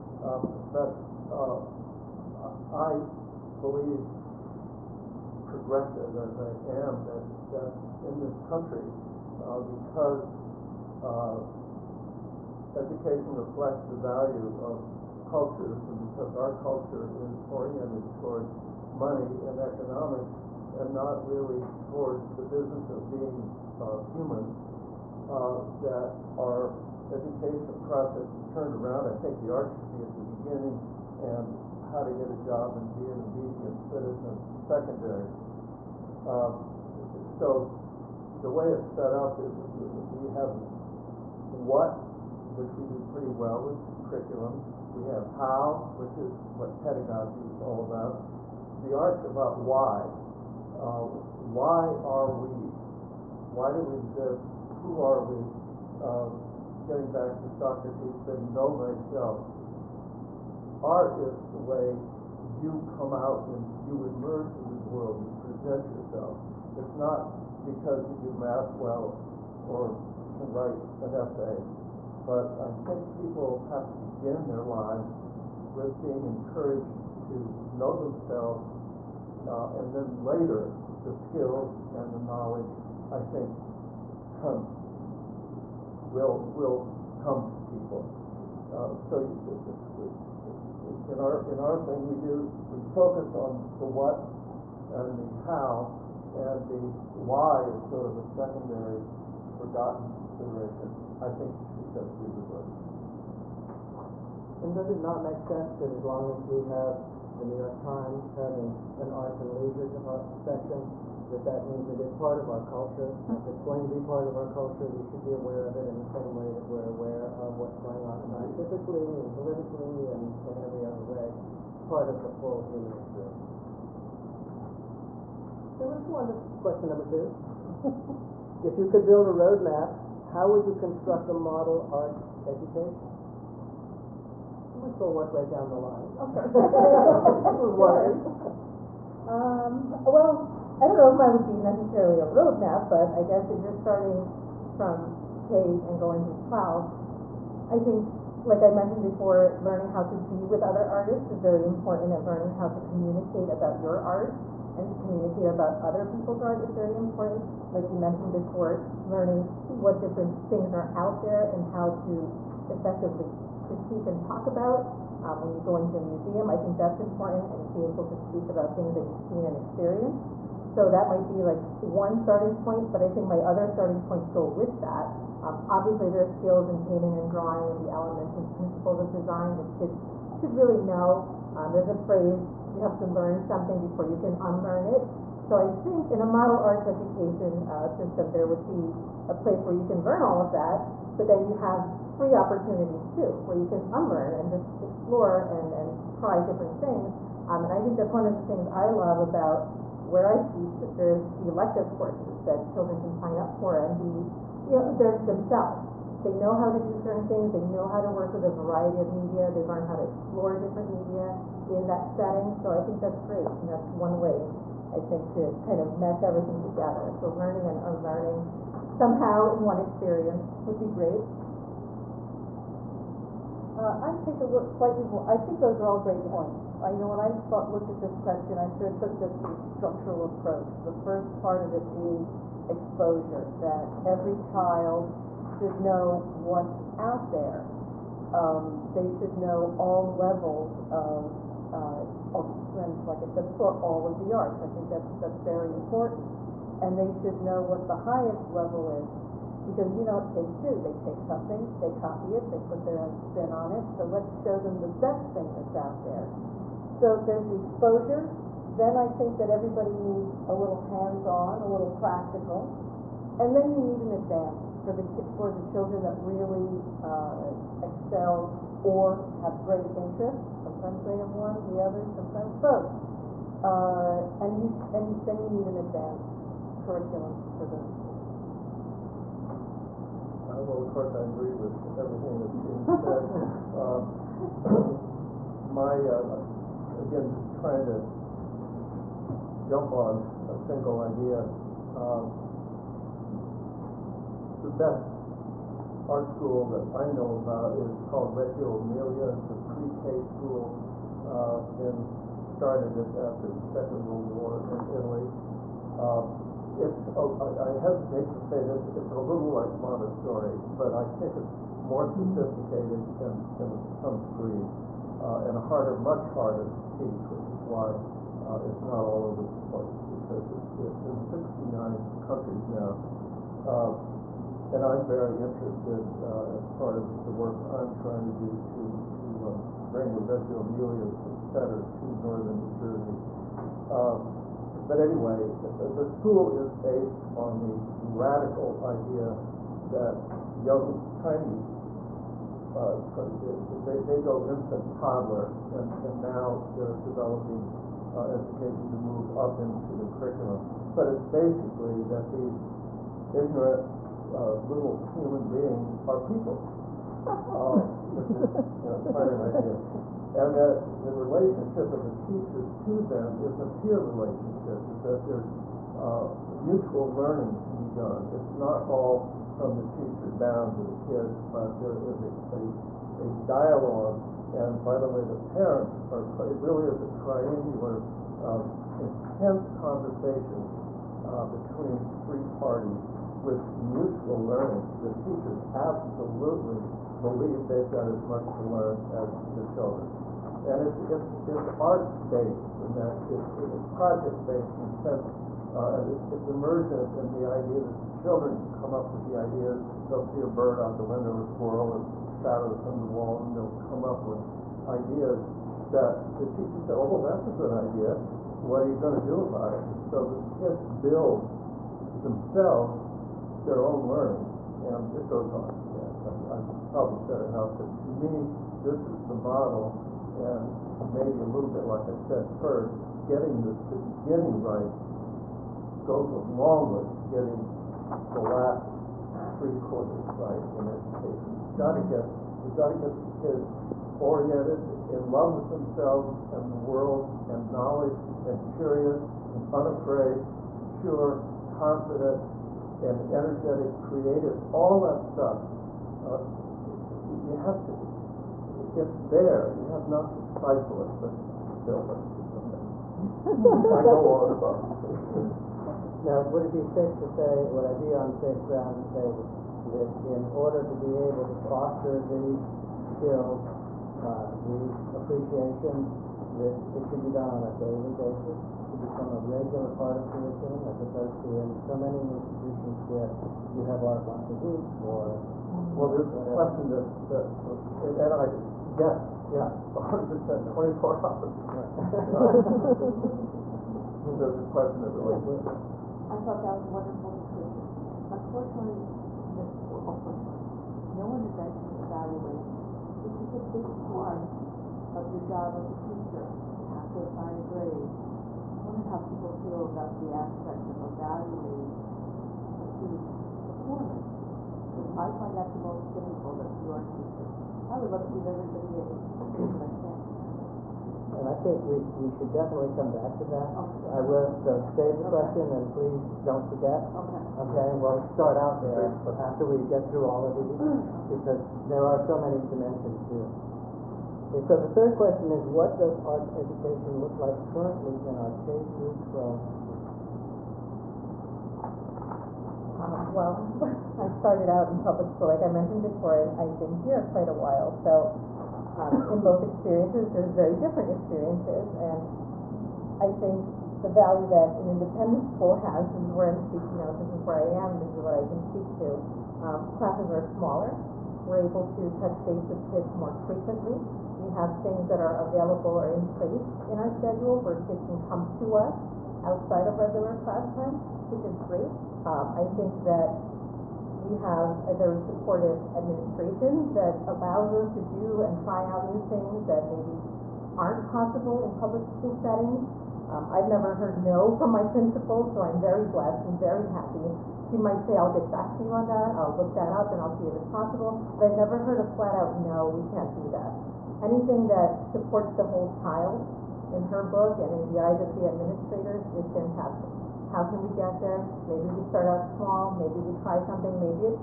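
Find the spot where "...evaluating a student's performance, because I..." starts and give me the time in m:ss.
8:21.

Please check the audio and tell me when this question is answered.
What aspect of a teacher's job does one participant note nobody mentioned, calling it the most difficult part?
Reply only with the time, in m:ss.
8:12.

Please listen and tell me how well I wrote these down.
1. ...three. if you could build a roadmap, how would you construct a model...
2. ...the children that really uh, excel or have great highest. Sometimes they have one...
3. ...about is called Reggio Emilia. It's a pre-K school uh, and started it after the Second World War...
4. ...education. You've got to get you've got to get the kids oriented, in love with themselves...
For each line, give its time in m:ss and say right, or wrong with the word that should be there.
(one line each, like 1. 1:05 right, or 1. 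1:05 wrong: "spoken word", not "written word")
1. 2:07 wrong: "two", not "three"
2. 4:25 wrong: "interest", not "highest"
3. 4:57 right
4. 7:10 right.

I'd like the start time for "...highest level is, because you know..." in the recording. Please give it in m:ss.
4:07.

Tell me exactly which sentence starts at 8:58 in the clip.
So um, in both experiences, there's very different experiences.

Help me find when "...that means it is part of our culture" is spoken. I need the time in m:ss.
1:51.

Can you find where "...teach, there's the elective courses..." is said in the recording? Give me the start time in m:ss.
3:20.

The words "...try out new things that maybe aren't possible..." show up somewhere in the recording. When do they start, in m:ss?
9:28.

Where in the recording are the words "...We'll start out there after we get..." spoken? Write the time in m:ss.
8:38.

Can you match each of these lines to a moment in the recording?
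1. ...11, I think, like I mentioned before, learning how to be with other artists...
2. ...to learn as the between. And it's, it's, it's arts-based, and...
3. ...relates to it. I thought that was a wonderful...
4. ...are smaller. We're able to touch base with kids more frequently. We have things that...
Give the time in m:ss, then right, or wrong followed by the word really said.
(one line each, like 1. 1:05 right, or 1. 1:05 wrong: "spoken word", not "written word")
1. 2:26 wrong: "12", not "11"
2. 6:28 wrong: "children", not "between"
3. 8:05 right
4. 9:10 right.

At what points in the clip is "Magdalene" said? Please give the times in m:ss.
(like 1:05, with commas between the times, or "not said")
not said.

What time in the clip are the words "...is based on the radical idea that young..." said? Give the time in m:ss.
5:36.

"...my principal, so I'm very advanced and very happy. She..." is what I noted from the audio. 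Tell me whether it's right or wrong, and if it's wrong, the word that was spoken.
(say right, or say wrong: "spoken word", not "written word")
wrong: "blessed", not "advanced".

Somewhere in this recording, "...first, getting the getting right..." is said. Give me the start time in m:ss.
7:02.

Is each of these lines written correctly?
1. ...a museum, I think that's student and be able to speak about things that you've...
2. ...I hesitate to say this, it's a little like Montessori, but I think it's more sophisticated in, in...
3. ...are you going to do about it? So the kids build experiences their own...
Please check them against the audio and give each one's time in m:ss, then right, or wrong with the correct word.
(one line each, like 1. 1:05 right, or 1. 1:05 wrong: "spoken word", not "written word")
1. 2:45 wrong: "important", not "student"
2. 5:07 right
3. 6:48 wrong: "themselves", not "experiences".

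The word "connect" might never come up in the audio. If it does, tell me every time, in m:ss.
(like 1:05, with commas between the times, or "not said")
not said.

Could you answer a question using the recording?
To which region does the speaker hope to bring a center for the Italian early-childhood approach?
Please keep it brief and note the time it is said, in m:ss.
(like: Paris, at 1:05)
northern New Jersey, at 5:32.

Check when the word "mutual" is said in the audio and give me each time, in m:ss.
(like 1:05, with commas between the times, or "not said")
6:06, 6:23.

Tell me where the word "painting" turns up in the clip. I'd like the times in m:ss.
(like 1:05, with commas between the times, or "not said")
2:56.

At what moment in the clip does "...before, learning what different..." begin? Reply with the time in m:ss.
2:38.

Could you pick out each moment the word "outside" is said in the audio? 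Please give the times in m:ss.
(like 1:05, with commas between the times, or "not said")
9:19.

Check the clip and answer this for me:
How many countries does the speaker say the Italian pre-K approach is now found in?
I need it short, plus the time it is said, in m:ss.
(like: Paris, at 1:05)
69, at 5:21.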